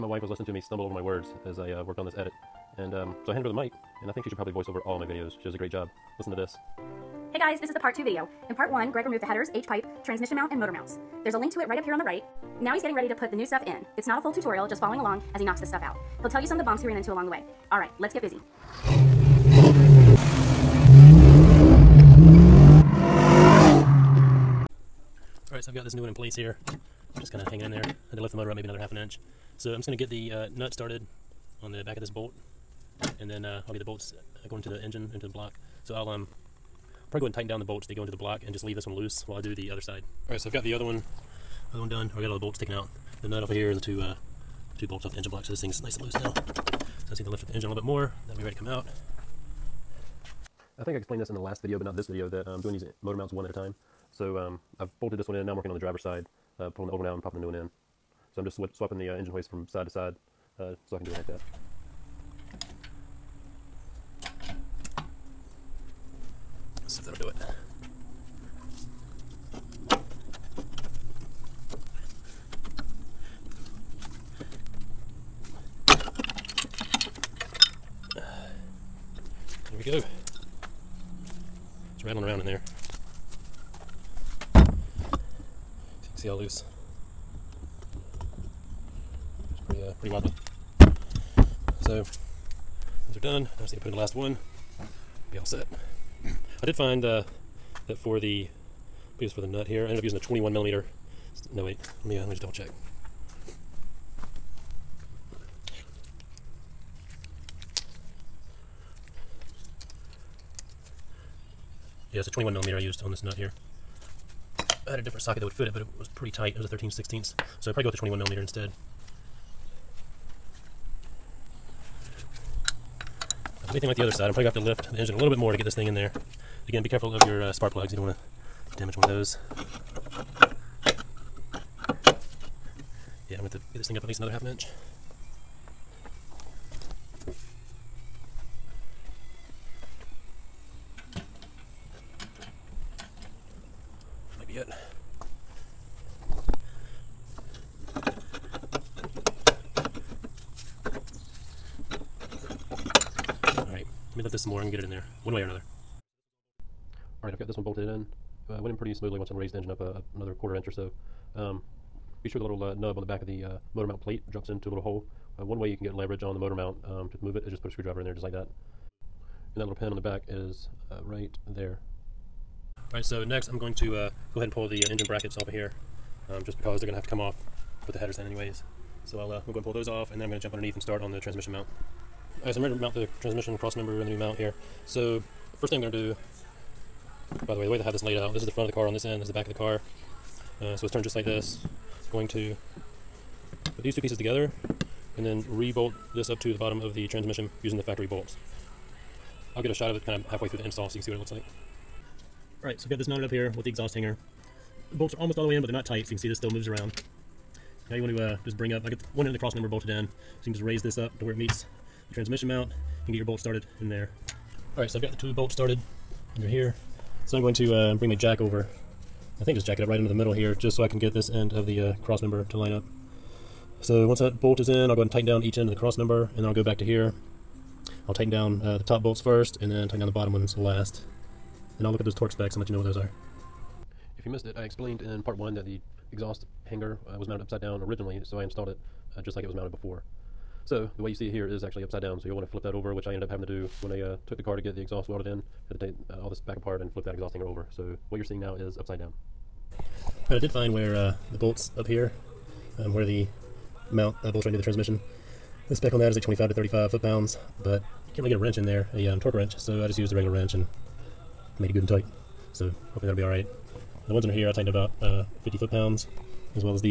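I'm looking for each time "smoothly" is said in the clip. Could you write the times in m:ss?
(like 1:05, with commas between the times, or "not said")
2:38.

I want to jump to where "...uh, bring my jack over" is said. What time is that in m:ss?
3:37.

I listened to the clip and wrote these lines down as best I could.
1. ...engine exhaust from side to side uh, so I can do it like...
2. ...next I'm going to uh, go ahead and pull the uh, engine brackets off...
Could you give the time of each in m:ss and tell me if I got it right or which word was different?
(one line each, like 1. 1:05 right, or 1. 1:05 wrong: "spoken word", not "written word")
1. 0:59 wrong: "hoist", not "exhaust"
2. 2:53 right.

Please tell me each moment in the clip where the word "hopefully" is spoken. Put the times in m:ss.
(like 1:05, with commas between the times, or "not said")
4:22.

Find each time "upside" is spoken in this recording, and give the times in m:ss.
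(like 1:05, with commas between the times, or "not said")
3:57, 4:01, 4:08.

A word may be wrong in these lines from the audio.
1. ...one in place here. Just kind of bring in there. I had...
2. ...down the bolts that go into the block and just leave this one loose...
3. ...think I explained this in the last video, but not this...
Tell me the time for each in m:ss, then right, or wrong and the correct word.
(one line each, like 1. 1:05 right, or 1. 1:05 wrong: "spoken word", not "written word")
1. 0:26 wrong: "hanging", not "bring"
2. 0:37 right
3. 0:50 right.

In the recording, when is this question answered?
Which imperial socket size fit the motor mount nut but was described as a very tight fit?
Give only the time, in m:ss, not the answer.
1:56.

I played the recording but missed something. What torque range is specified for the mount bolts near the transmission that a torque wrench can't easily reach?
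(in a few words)
25 to 35 foot-pounds.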